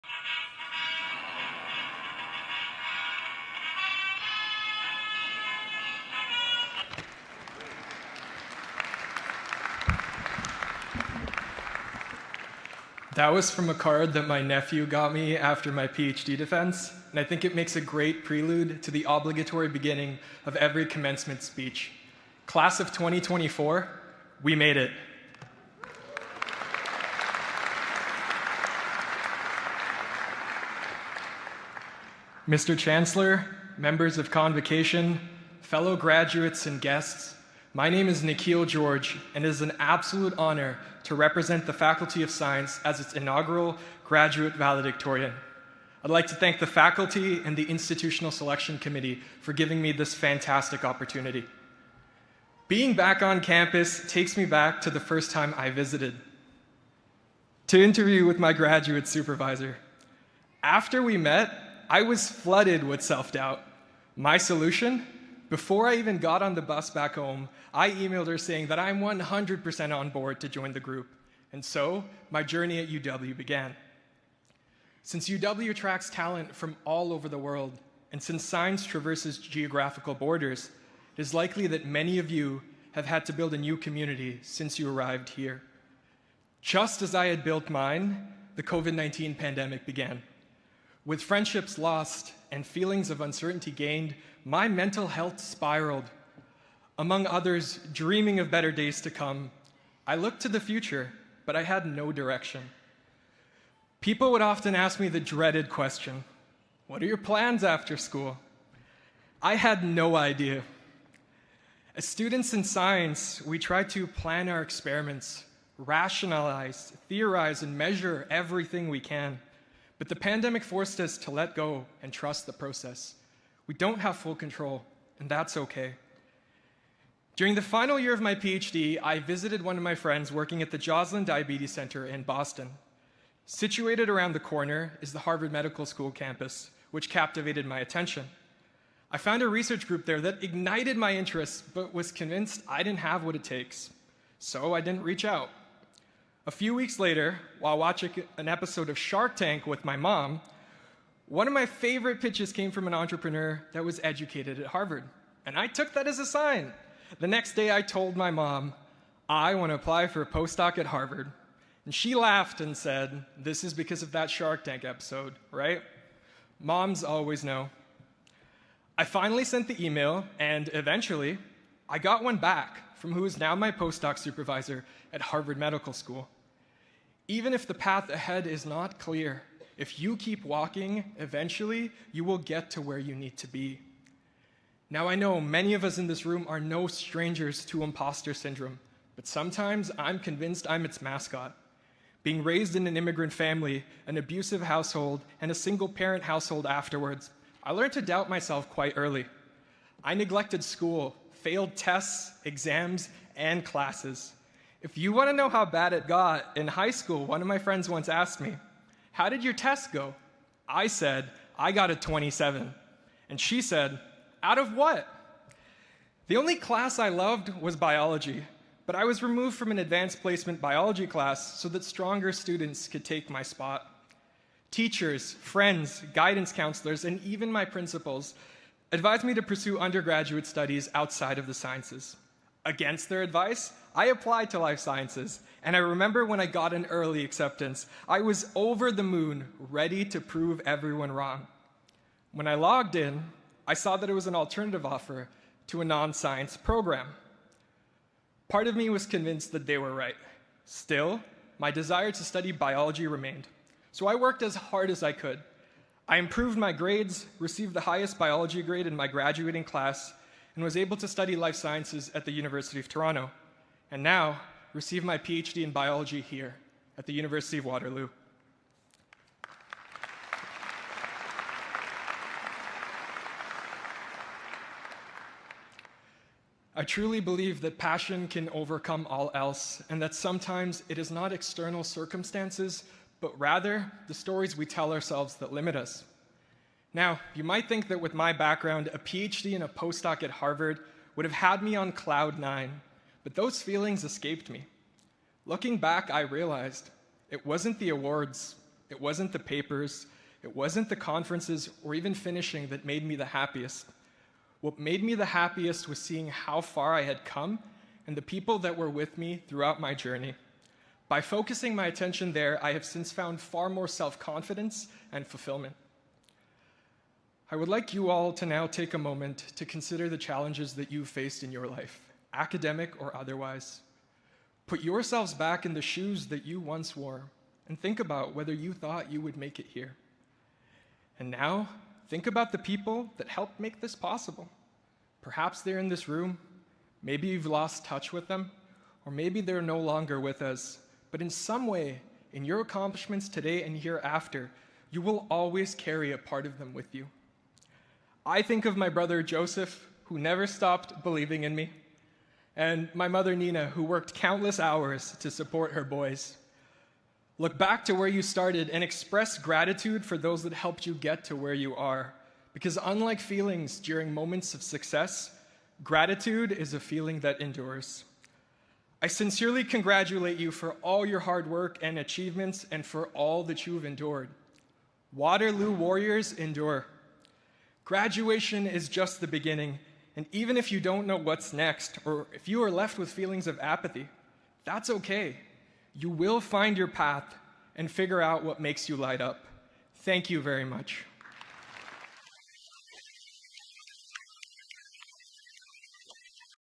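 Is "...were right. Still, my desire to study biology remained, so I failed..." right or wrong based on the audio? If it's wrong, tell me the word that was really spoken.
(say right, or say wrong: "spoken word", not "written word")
wrong: "worked", not "failed".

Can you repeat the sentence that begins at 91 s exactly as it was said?
With friendships lost and feelings of uncertainty gained, my mental health spiraled.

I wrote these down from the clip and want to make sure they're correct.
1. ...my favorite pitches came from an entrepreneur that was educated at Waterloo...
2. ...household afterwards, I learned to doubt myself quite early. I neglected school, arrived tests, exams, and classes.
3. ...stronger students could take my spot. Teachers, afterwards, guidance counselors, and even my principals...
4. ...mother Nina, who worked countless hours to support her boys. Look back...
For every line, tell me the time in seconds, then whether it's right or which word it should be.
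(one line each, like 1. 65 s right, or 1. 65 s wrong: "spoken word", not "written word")
1. 151 s wrong: "Harvard", not "Waterloo"
2. 196 s wrong: "failed", not "arrived"
3. 221 s wrong: "friends", not "afterwards"
4. 353 s right.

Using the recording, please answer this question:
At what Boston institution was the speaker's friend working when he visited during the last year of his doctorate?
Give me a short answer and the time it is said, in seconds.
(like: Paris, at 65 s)
Joslin Diabetes Center, at 130 s.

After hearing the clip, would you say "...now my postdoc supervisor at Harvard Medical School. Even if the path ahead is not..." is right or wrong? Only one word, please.
right.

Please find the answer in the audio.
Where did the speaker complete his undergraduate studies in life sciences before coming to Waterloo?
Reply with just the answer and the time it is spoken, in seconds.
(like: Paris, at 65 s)
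University of Toronto, at 262 s.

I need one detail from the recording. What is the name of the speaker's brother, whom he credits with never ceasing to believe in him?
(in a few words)
Joseph.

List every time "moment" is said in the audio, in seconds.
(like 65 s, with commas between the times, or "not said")
318 s, 364 s.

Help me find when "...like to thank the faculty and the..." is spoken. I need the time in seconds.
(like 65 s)
46 s.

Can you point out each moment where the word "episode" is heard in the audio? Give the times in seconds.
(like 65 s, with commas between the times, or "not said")
148 s, 164 s.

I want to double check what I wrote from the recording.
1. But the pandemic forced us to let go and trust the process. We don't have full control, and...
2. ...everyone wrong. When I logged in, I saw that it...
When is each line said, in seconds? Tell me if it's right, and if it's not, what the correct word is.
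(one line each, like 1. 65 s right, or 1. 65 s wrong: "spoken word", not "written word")
1. 120 s right
2. 240 s right.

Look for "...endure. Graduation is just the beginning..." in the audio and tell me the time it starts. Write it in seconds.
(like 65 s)
376 s.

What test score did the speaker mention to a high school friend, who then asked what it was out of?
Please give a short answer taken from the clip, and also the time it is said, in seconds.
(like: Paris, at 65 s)
27, at 211 s.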